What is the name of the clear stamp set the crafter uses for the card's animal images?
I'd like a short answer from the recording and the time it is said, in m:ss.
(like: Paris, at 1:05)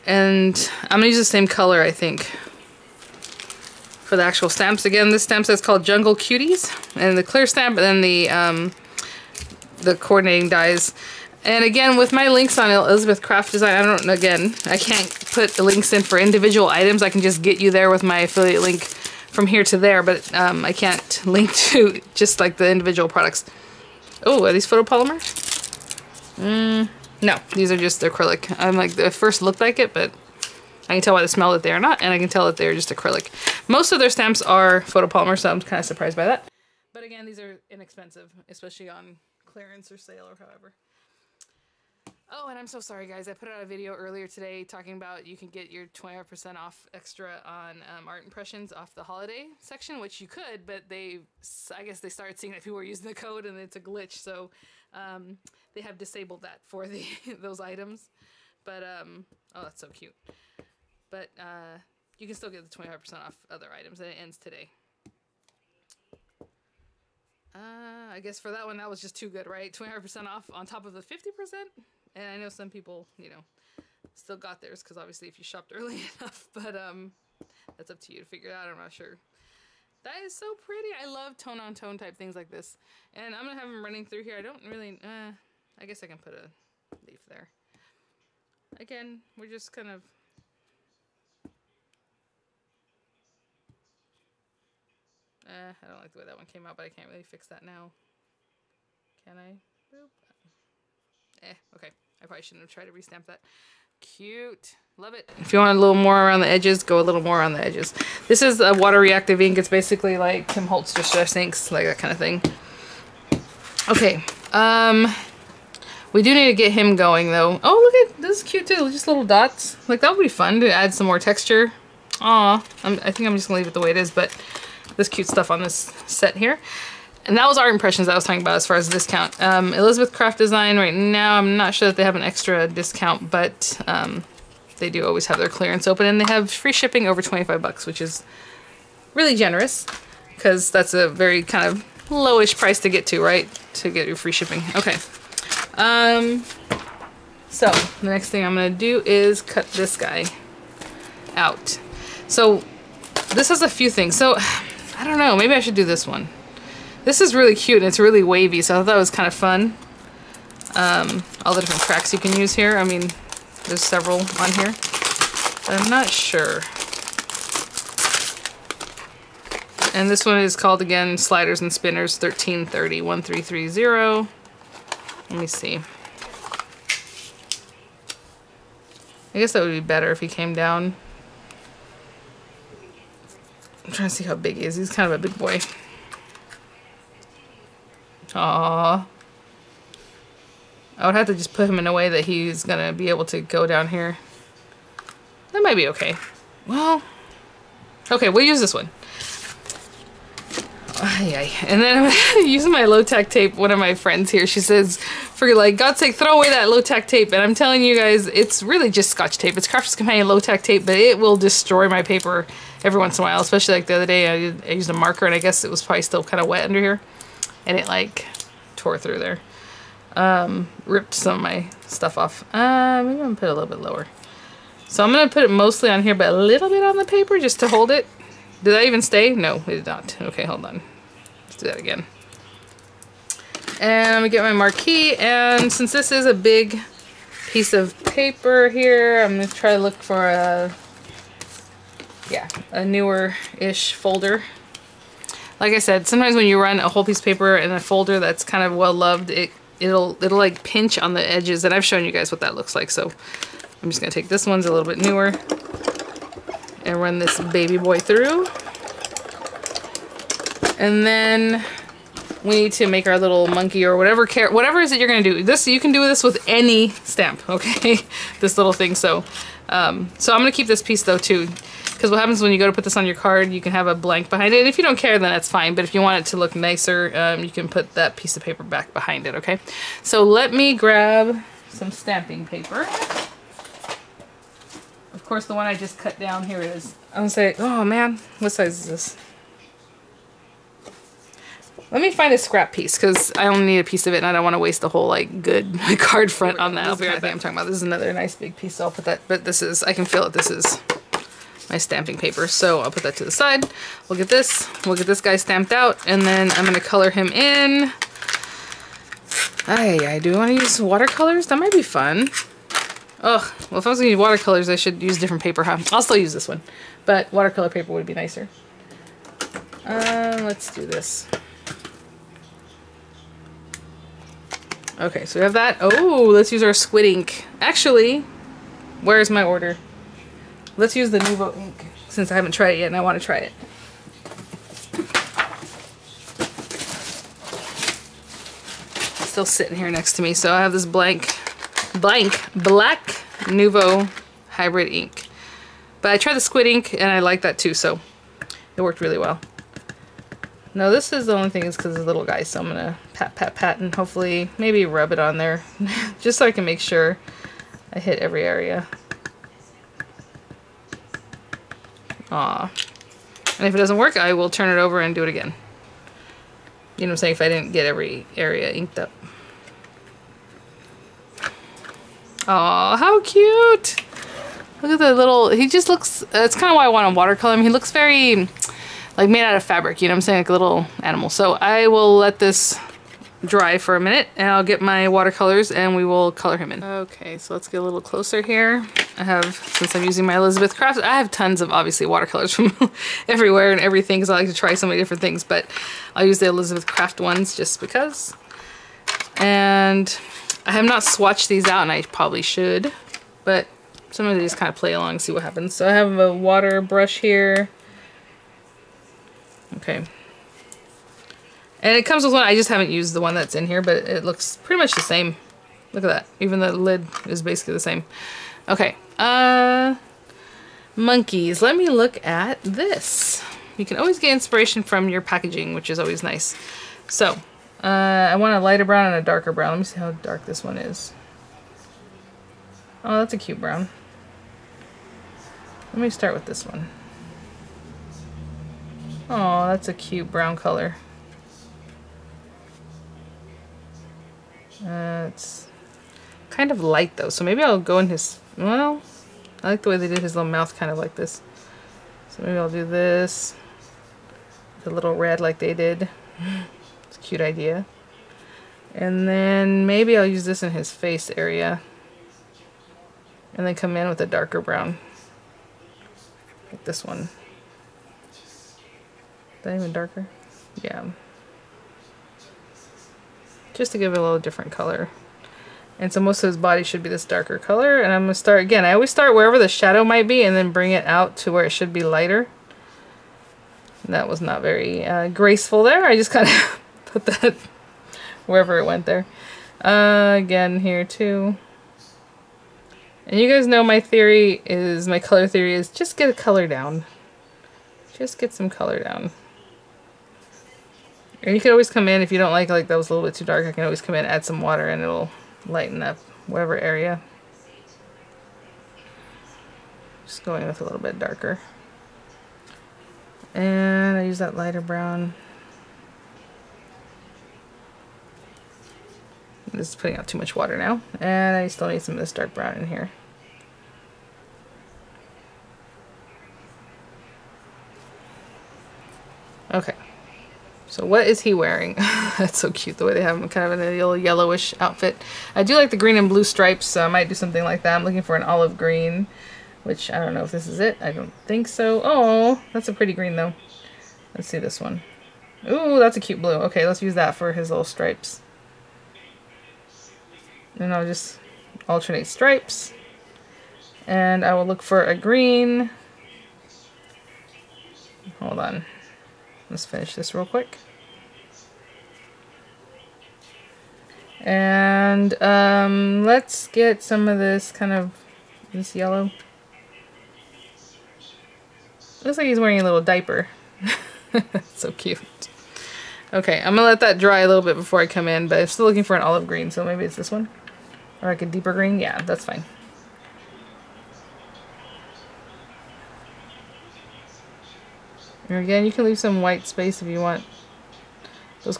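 Jungle Cuties, at 0:05.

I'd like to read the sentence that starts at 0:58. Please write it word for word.
But, um, oh, that's so cute.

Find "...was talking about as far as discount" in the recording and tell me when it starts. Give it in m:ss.
2:08.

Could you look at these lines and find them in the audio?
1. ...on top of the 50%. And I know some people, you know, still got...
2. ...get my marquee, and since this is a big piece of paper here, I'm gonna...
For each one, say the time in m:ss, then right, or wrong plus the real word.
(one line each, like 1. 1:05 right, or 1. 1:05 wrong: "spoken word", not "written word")
1. 1:10 right
2. 3:54 right.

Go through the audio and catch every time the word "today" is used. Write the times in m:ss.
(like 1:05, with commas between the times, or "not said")
0:44, 1:04.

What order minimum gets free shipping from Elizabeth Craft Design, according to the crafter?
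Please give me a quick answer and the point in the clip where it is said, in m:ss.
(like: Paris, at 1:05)
$25, at 2:17.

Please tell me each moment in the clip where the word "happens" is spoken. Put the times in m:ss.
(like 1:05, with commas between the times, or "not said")
4:32, 6:45.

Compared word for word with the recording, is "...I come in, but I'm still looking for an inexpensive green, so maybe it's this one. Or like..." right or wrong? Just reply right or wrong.
wrong.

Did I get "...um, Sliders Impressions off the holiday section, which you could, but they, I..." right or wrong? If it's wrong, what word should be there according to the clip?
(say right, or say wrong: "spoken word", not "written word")
wrong: "Art", not "Sliders".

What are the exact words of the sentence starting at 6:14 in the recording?
Look at the little, he just looks, that's kind of why I want to watercolor him.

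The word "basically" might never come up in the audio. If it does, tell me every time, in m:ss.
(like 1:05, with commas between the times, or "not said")
1:49, 6:57.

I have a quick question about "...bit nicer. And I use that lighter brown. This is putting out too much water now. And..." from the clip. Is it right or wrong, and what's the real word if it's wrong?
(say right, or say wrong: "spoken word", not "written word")
wrong: "darker", not "nicer".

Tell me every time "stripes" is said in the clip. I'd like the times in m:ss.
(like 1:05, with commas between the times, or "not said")
8:56, 9:07, 9:12.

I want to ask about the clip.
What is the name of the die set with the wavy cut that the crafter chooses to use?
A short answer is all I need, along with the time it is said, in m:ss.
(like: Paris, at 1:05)
Sliders and Spinners, at 2:51.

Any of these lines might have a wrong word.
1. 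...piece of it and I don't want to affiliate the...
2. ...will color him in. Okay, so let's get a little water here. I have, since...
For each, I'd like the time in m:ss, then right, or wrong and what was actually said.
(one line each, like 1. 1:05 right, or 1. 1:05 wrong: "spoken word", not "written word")
1. 4:53 wrong: "waste", not "affiliate"
2. 6:26 wrong: "closer", not "water".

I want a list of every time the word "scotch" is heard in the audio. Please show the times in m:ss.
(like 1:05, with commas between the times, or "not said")
3:29.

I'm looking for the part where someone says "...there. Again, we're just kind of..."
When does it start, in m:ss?
1:27.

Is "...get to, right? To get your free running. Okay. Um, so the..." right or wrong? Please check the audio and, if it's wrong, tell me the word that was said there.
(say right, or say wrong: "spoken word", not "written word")
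wrong: "shipping", not "running".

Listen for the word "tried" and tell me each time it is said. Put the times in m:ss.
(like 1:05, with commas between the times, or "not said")
1:42, 5:32, 5:46.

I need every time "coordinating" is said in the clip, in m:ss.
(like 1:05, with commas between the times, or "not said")
0:09.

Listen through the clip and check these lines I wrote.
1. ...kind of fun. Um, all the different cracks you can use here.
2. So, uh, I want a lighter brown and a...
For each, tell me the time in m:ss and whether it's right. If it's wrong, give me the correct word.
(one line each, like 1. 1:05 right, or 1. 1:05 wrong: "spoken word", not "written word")
1. 2:39 right
2. 7:07 right.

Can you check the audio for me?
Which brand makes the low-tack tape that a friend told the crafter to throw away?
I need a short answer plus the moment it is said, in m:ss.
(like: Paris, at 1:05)
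Crafter's Companion, at 3:29.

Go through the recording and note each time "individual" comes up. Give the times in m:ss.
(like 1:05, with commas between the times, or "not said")
0:16, 0:22.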